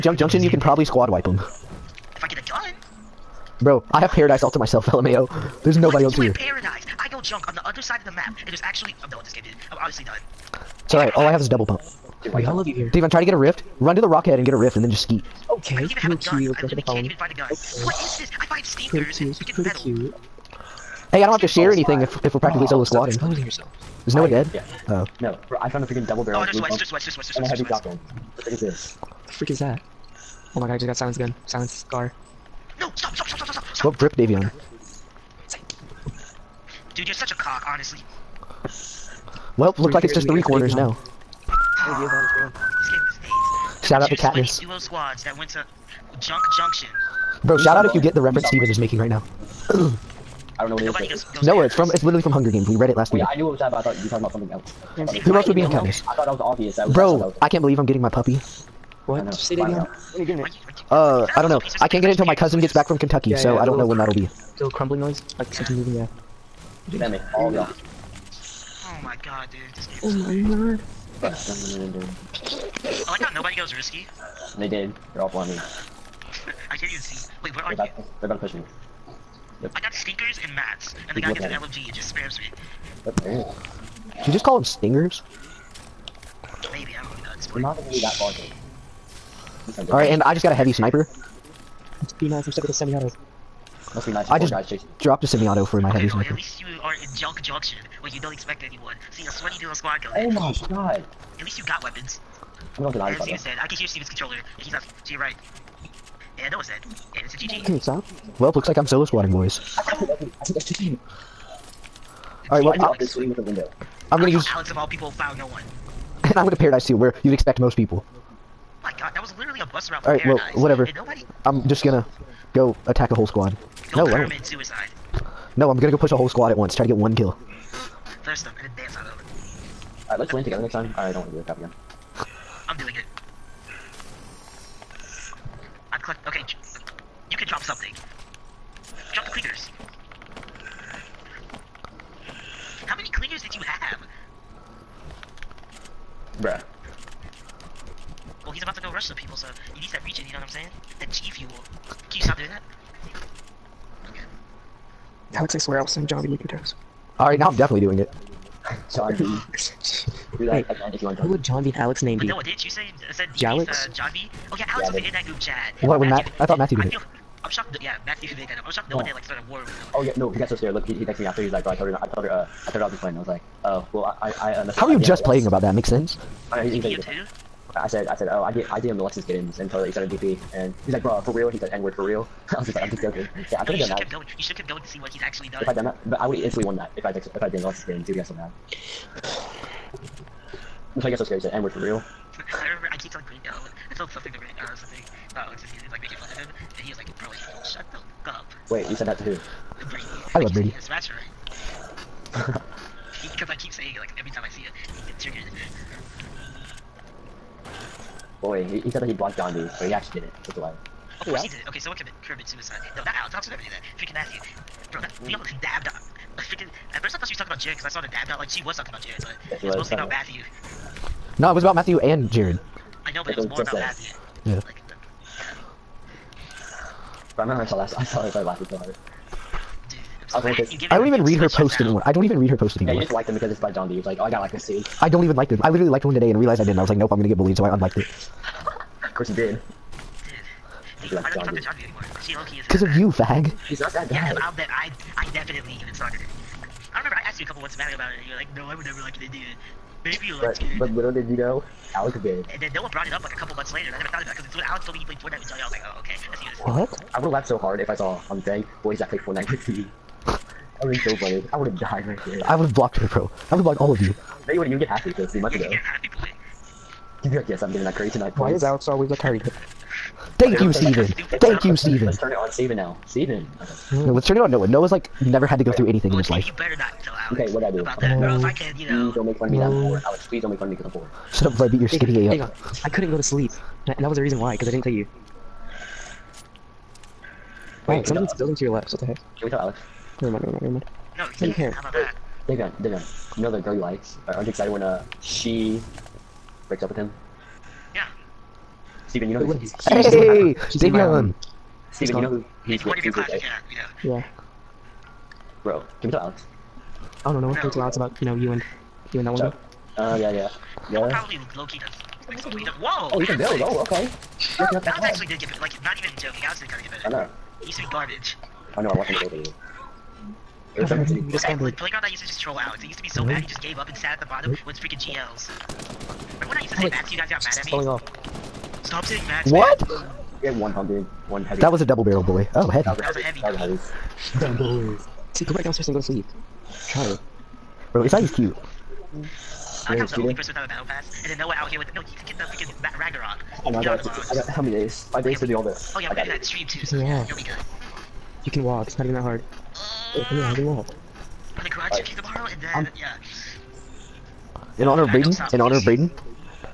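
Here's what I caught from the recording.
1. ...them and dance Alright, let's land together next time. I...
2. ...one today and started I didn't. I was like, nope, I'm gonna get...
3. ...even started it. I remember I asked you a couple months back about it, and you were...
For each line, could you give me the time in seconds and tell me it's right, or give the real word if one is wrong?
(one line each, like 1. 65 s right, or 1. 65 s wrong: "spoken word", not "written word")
1. 128 s right
2. 236 s wrong: "realized", not "started"
3. 245 s right.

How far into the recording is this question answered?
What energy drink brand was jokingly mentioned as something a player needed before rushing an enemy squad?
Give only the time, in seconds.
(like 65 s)
151 s.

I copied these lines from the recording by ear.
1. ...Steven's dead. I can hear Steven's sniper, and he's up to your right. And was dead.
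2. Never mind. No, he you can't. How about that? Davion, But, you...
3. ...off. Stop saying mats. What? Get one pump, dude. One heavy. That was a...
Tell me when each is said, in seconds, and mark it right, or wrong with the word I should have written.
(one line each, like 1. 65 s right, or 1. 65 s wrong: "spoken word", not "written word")
1. 103 s wrong: "controller", not "sniper"
2. 290 s wrong: "Davion", not "But"
3. 327 s right.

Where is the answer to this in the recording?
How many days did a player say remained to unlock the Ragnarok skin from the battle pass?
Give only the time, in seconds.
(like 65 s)
345 s.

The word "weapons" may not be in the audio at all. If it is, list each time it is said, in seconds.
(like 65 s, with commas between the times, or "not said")
101 s.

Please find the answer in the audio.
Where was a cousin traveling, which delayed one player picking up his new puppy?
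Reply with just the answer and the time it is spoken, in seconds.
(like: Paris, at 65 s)
Kentucky, at 62 s.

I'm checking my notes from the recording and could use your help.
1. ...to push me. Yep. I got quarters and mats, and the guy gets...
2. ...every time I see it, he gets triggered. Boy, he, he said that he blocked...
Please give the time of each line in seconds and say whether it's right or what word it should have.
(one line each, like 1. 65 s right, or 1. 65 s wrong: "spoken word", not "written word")
1. 78 s wrong: "stinkers", not "quarters"
2. 204 s right.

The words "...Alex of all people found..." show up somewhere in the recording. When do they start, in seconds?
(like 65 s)
114 s.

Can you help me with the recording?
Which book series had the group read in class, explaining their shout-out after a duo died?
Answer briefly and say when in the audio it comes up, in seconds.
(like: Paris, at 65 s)
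Hunger Games, at 52 s.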